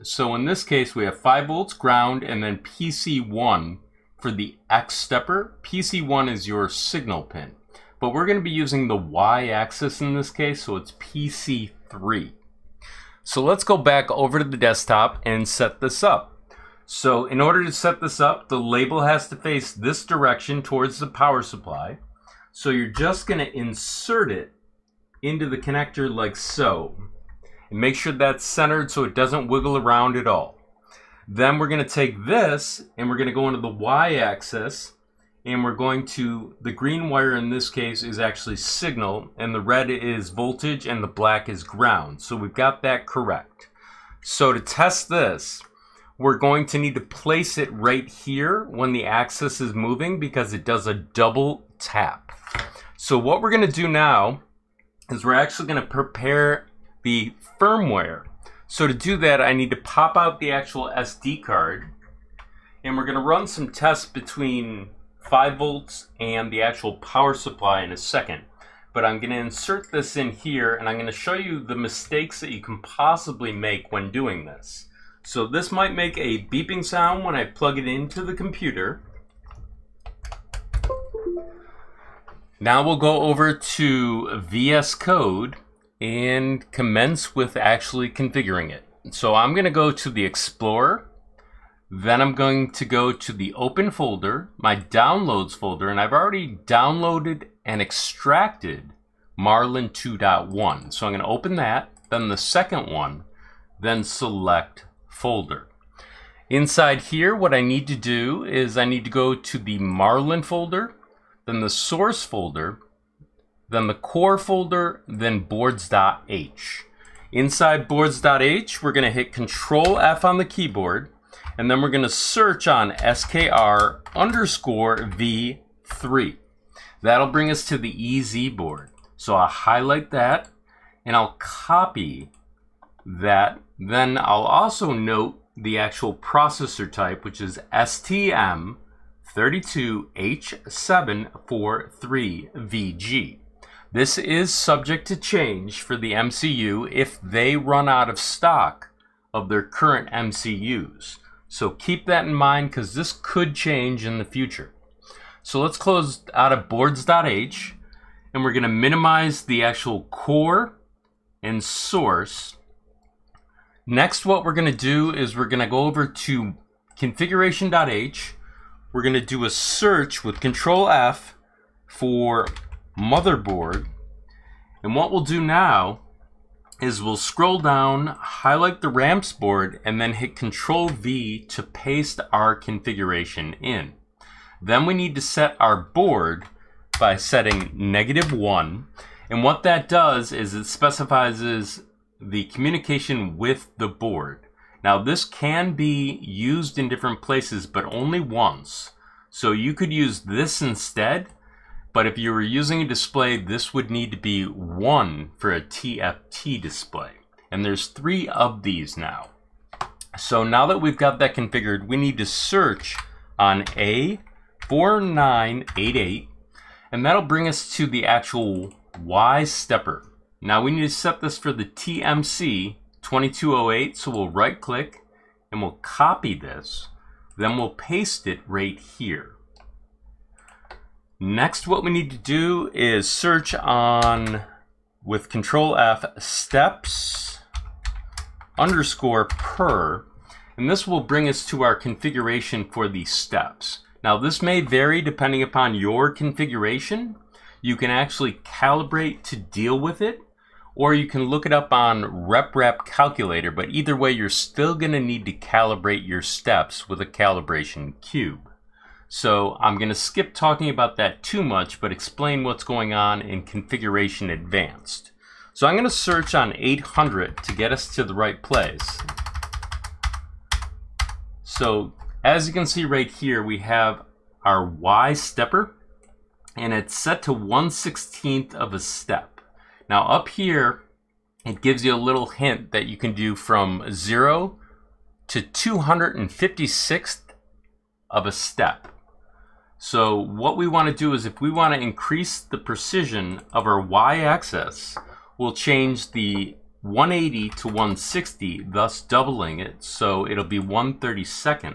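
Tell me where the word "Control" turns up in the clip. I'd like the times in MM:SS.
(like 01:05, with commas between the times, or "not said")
01:59, 02:50, 03:00, 03:55.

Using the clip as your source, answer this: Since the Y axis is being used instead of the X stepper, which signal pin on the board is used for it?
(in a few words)
PC3.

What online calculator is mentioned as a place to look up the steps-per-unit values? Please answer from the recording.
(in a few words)
RepRap Calculator.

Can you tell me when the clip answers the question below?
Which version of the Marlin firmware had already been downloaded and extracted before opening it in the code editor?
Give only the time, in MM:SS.
01:39.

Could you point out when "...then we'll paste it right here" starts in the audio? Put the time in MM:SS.
03:47.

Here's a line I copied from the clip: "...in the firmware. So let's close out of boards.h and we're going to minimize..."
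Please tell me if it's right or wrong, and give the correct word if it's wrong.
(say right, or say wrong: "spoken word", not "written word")
wrong: "future", not "firmware".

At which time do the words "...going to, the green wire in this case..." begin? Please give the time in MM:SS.
00:35.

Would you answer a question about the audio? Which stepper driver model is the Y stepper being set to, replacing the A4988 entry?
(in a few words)
TMC 2208.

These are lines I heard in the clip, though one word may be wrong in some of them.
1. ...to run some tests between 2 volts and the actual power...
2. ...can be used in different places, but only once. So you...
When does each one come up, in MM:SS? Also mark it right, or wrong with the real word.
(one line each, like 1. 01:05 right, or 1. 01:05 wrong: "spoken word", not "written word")
1. 01:03 wrong: "5", not "2"
2. 03:15 right.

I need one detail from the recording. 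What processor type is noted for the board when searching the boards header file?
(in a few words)
STM32H743VG.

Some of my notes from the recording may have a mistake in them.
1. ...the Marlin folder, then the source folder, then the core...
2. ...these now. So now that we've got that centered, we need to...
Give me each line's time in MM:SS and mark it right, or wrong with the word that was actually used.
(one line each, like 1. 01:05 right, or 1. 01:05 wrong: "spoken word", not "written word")
1. 01:49 right
2. 03:28 wrong: "configured", not "centered".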